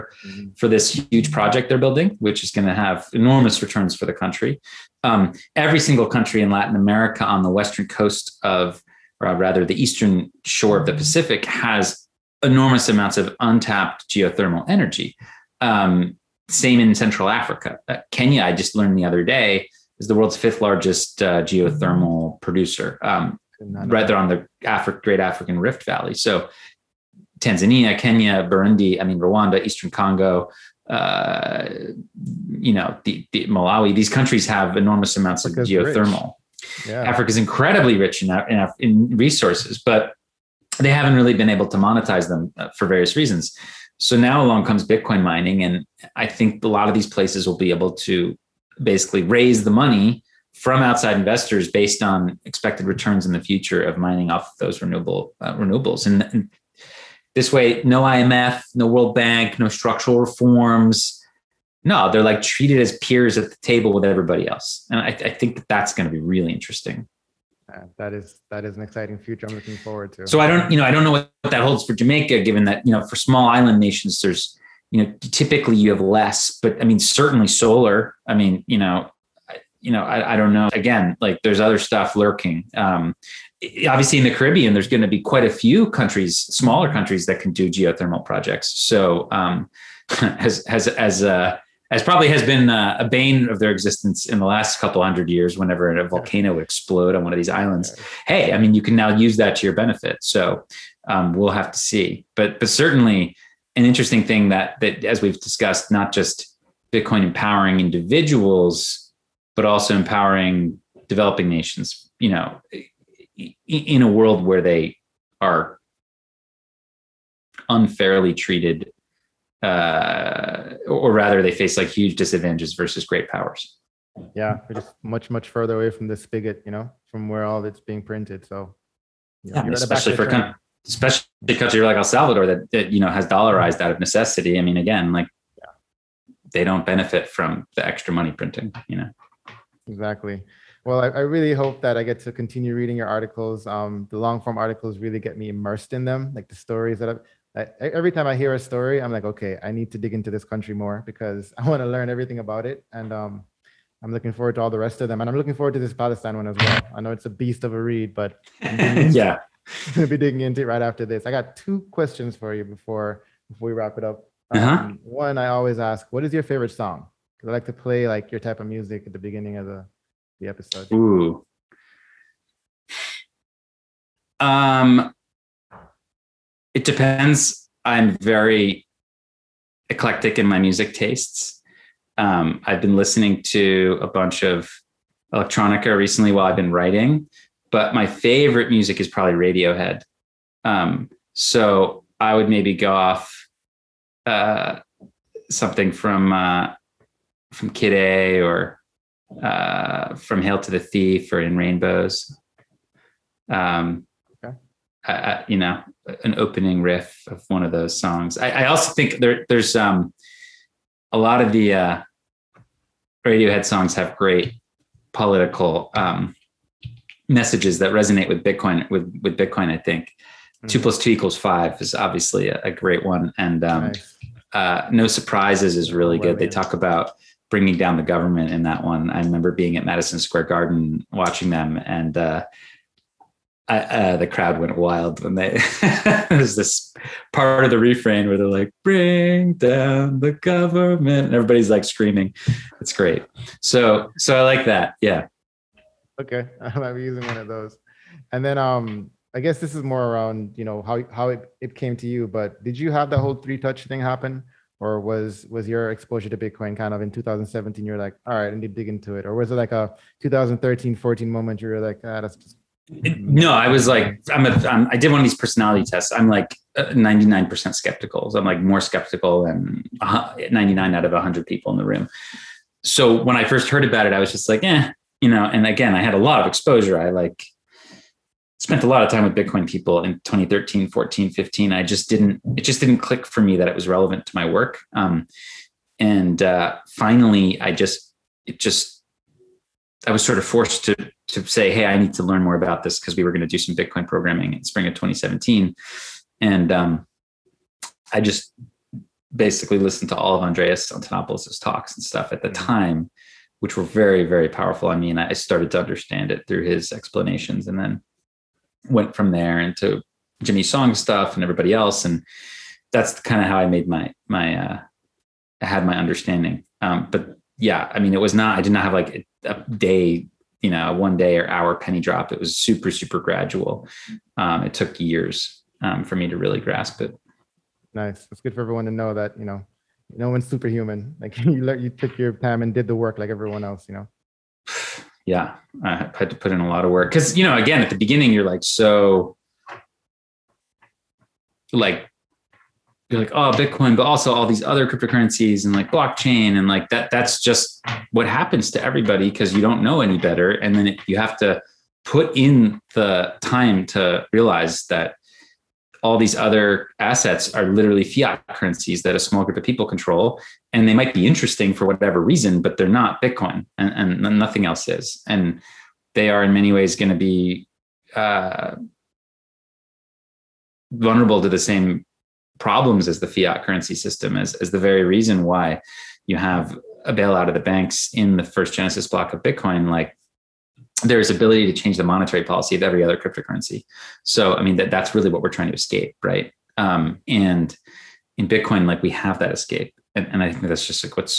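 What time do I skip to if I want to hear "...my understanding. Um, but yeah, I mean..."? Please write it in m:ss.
5:15.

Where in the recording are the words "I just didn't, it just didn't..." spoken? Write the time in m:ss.
4:41.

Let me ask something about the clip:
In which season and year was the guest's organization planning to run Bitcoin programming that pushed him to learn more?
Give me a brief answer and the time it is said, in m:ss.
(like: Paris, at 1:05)
spring of 2017, at 4:54.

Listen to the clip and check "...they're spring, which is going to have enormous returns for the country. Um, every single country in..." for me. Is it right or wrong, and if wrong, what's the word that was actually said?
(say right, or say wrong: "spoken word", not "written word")
wrong: "building", not "spring".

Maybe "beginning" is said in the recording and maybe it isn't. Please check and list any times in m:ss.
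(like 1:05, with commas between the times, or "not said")
2:49, 5:37.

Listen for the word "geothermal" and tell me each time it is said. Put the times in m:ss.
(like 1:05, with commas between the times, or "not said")
0:14, 0:21, 0:35, 1:27.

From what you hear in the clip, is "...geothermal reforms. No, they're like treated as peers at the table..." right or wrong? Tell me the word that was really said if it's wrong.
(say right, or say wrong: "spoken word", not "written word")
wrong: "structural", not "geothermal".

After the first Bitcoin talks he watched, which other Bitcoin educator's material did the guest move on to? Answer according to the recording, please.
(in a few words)
Jimmy Song.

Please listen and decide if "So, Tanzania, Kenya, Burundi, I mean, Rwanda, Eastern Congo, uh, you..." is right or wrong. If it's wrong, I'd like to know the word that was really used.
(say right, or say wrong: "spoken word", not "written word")
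right.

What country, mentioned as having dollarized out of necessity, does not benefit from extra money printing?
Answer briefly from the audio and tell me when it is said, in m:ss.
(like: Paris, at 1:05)
El Salvador, at 2:11.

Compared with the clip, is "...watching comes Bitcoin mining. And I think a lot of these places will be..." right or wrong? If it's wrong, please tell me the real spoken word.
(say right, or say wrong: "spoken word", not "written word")
wrong: "along", not "watching".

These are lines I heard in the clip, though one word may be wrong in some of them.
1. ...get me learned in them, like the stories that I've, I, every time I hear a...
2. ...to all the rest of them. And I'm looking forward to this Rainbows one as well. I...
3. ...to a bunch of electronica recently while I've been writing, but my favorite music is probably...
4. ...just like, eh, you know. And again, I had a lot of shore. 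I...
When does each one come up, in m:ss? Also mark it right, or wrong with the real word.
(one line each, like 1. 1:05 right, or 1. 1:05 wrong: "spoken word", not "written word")
1. 2:25 wrong: "immersed", not "learned"
2. 2:34 wrong: "Palestine", not "Rainbows"
3. 3:03 right
4. 4:34 wrong: "exposure", not "shore".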